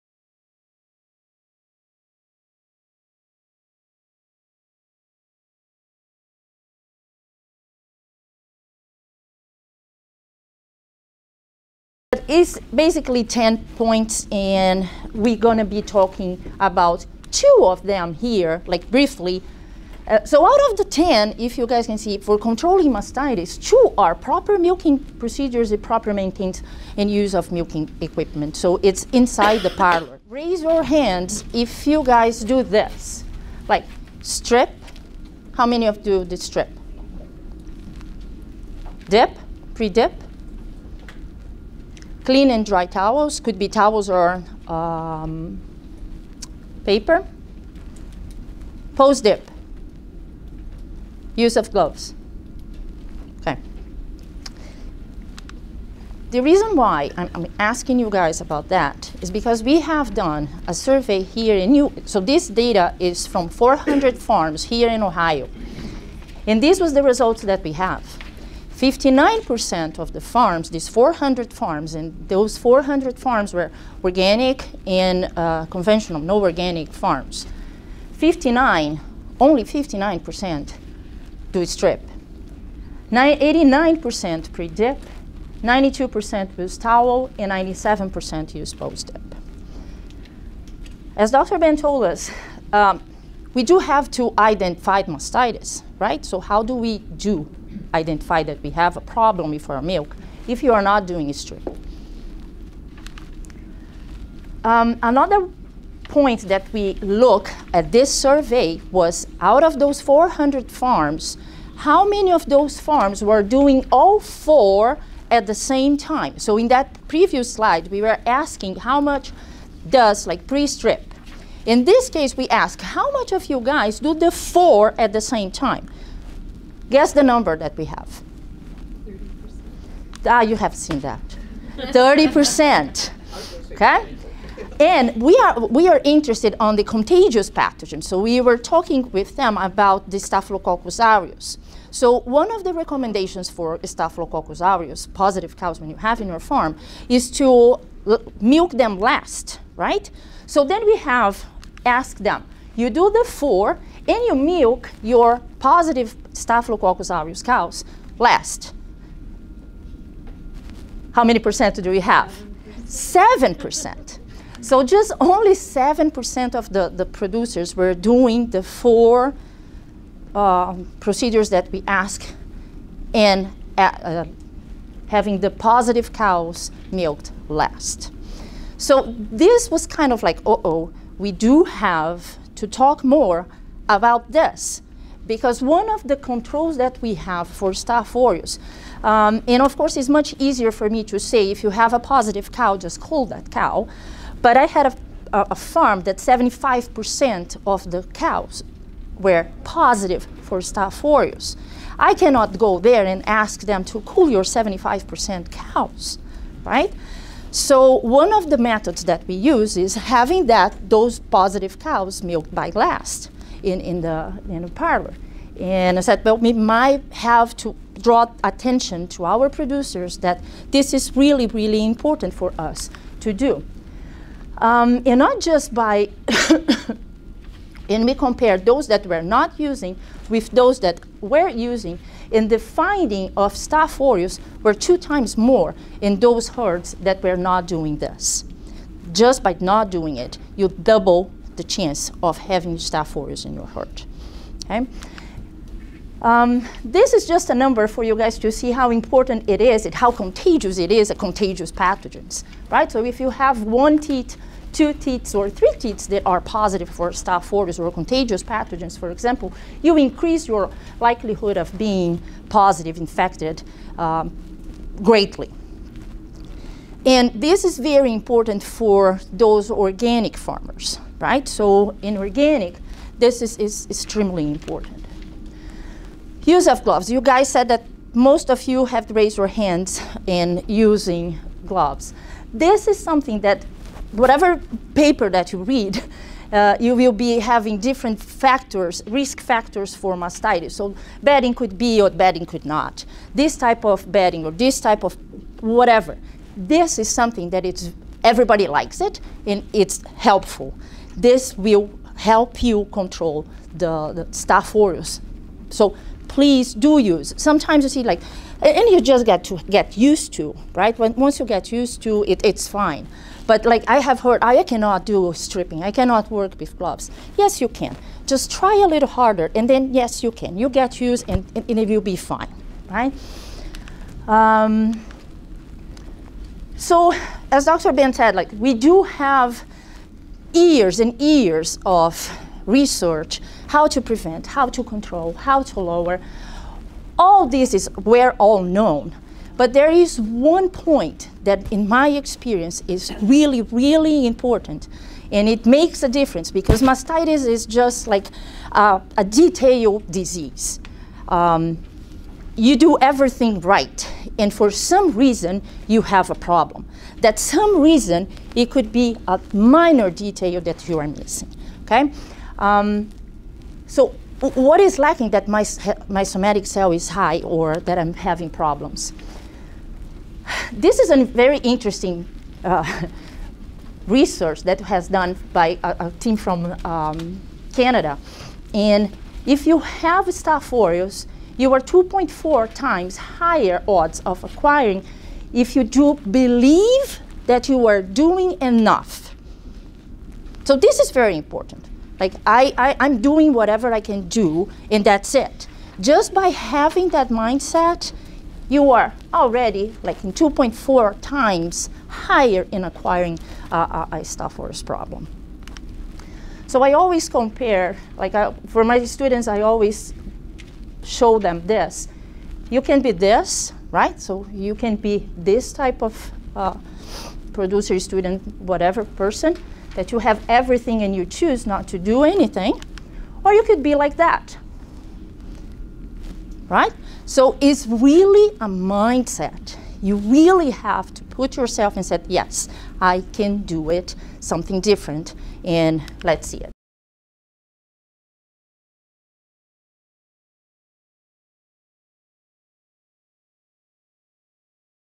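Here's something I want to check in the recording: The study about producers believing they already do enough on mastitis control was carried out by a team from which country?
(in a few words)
Canada.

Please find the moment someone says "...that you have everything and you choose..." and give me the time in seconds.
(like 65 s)
419 s.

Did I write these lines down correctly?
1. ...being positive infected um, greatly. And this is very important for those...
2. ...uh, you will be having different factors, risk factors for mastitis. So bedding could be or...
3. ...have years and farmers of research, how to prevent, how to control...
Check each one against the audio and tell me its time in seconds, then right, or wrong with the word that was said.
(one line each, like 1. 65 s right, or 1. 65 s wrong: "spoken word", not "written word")
1. 261 s right
2. 286 s right
3. 329 s wrong: "years", not "farmers".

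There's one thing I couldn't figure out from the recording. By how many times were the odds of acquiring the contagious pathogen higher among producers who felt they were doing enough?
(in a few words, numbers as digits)
2.4.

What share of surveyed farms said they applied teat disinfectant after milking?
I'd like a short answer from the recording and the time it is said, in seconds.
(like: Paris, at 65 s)
97%, at 87 s.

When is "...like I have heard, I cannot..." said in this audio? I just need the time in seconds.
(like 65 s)
313 s.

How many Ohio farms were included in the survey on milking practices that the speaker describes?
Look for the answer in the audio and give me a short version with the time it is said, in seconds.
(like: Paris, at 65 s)
400, at 62 s.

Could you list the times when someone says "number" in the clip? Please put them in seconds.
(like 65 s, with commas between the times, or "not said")
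127 s, 247 s.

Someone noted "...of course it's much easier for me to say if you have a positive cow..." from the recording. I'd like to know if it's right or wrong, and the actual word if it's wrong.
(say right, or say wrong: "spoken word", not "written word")
right.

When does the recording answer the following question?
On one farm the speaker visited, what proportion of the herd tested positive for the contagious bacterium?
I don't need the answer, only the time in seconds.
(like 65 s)
196 s.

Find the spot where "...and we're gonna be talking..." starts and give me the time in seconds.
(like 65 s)
14 s.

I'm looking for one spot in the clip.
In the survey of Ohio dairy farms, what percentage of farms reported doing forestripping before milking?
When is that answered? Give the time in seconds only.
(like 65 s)
78 s.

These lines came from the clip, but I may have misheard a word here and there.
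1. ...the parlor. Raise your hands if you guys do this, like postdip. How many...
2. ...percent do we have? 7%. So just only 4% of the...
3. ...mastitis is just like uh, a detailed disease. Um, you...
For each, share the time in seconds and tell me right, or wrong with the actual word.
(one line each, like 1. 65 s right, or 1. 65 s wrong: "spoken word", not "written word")
1. 29 s wrong: "strip", not "postdip"
2. 161 s wrong: "7", not "4"
3. 346 s right.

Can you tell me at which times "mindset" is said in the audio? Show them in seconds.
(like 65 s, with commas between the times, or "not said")
397 s, 428 s.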